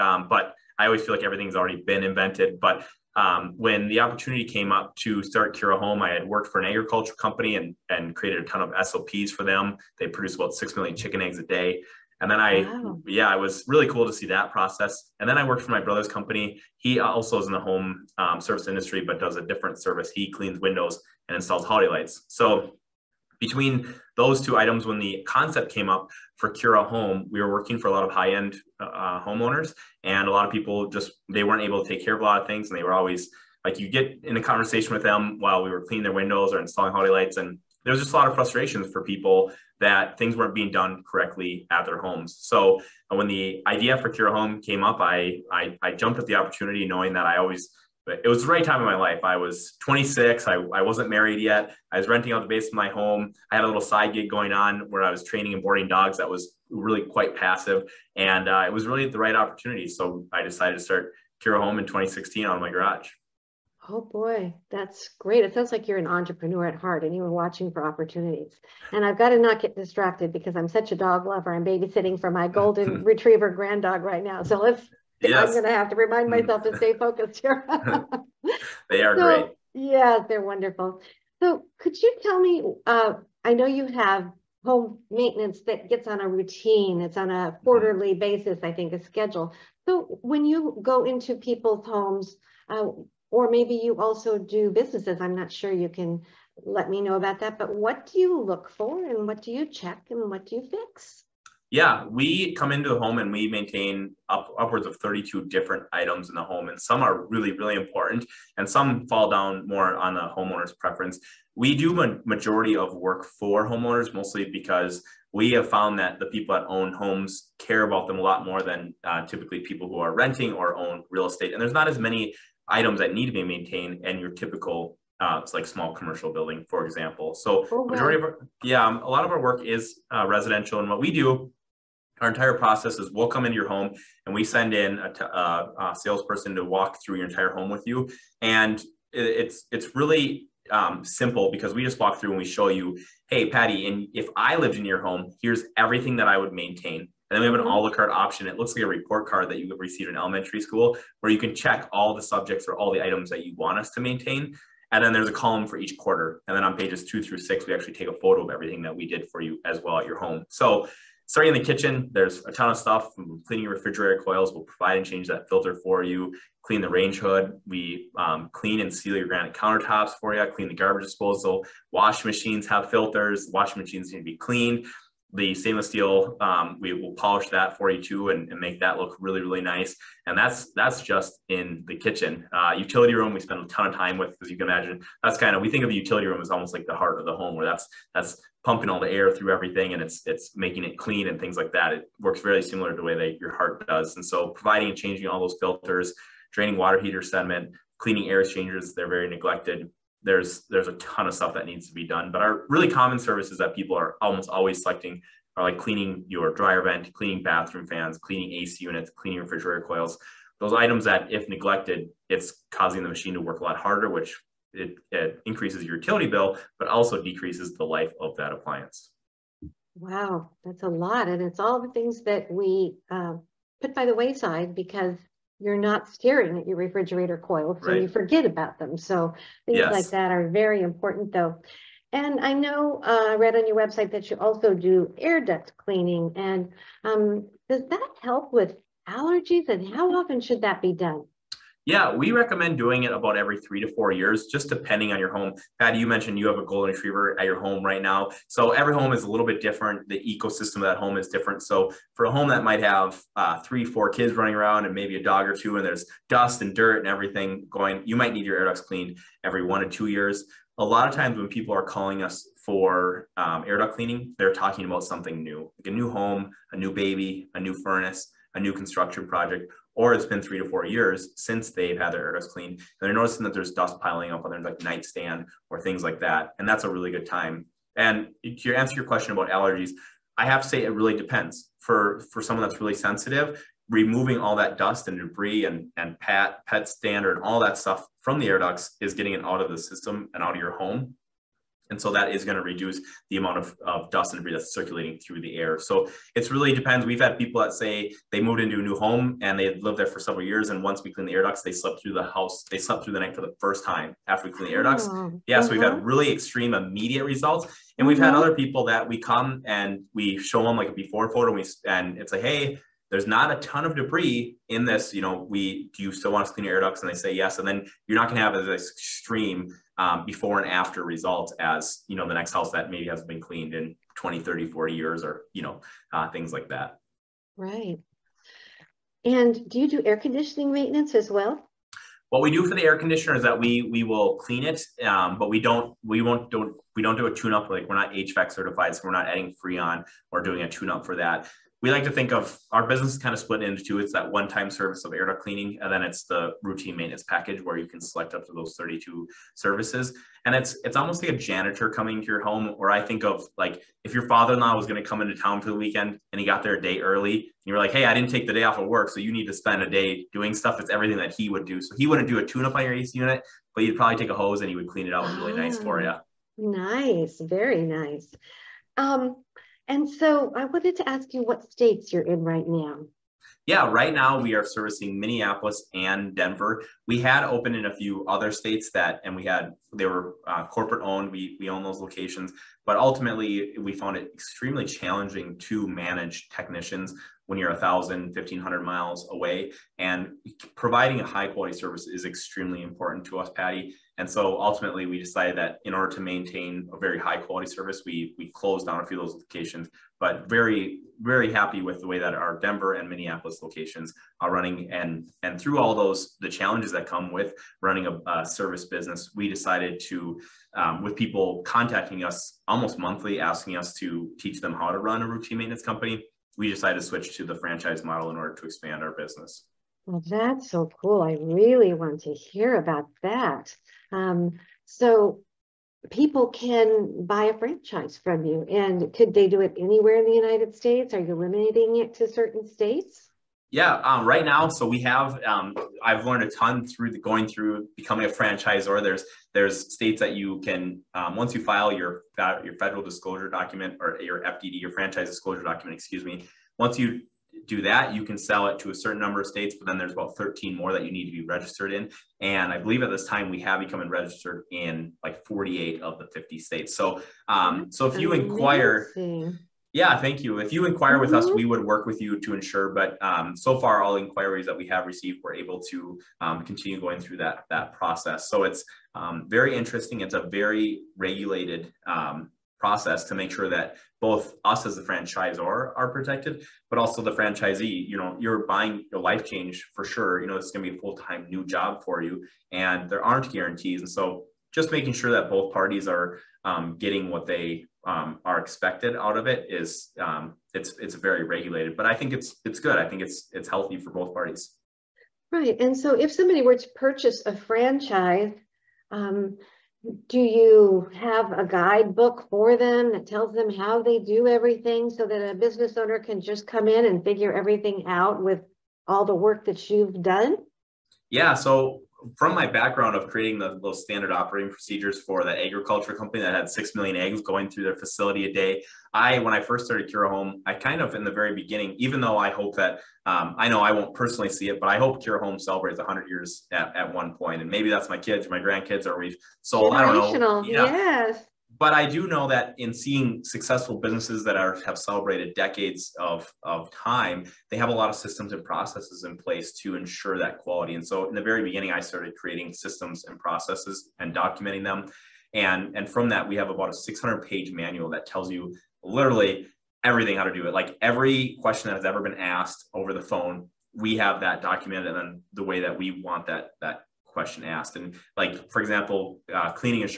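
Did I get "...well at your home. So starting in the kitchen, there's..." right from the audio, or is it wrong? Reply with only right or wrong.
right.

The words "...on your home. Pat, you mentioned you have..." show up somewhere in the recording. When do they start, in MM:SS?
04:05.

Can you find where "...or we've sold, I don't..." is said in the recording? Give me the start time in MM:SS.
08:49.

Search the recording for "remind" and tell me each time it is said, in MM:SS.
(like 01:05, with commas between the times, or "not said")
01:15.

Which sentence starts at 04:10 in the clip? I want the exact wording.
The ecosystem of that home is different.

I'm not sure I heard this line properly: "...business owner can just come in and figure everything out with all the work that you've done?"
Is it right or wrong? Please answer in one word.
right.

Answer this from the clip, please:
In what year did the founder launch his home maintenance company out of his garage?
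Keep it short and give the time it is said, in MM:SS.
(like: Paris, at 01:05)
2016, at 01:01.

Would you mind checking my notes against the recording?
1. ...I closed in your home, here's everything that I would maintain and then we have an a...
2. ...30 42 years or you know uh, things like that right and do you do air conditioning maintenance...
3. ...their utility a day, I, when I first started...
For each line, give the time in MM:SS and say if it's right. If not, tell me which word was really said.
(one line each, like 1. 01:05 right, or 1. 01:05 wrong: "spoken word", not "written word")
1. 02:24 wrong: "lived", not "closed"
2. 05:24 wrong: "40", not "42"
3. 08:37 wrong: "facility", not "utility".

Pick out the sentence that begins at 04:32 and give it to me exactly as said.
And they're noticing that there's dust piling up on their like nightstand or things like that.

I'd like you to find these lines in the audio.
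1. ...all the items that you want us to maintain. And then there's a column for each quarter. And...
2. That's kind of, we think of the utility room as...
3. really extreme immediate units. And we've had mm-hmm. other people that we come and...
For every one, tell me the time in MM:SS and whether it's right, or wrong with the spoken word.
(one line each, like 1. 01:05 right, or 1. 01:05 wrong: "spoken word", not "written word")
1. 02:32 right
2. 03:05 right
3. 05:06 wrong: "results", not "units".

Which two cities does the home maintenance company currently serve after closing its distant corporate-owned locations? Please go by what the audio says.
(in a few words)
Minneapolis and Denver.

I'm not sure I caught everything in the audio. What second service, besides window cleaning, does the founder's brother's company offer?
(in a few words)
installs holiday lights.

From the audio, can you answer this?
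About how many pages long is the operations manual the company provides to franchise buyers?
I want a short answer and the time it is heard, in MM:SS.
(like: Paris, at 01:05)
600, at 09:06.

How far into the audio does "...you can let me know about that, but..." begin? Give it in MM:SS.
01:35.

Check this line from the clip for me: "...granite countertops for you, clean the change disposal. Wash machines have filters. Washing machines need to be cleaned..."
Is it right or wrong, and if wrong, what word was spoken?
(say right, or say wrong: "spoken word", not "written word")
wrong: "garbage", not "change".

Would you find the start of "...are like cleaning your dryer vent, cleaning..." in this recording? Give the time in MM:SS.
03:25.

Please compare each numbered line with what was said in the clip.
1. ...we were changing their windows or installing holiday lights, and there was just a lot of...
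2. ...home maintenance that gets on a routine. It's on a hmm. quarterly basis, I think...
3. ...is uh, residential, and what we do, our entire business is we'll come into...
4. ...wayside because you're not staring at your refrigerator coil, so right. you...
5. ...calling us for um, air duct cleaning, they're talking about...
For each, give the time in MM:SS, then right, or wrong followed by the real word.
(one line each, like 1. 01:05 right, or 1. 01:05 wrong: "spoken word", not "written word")
1. 00:35 wrong: "cleaning", not "changing"
2. 01:24 right
3. 02:09 wrong: "process", not "business"
4. 03:44 right
5. 04:21 right.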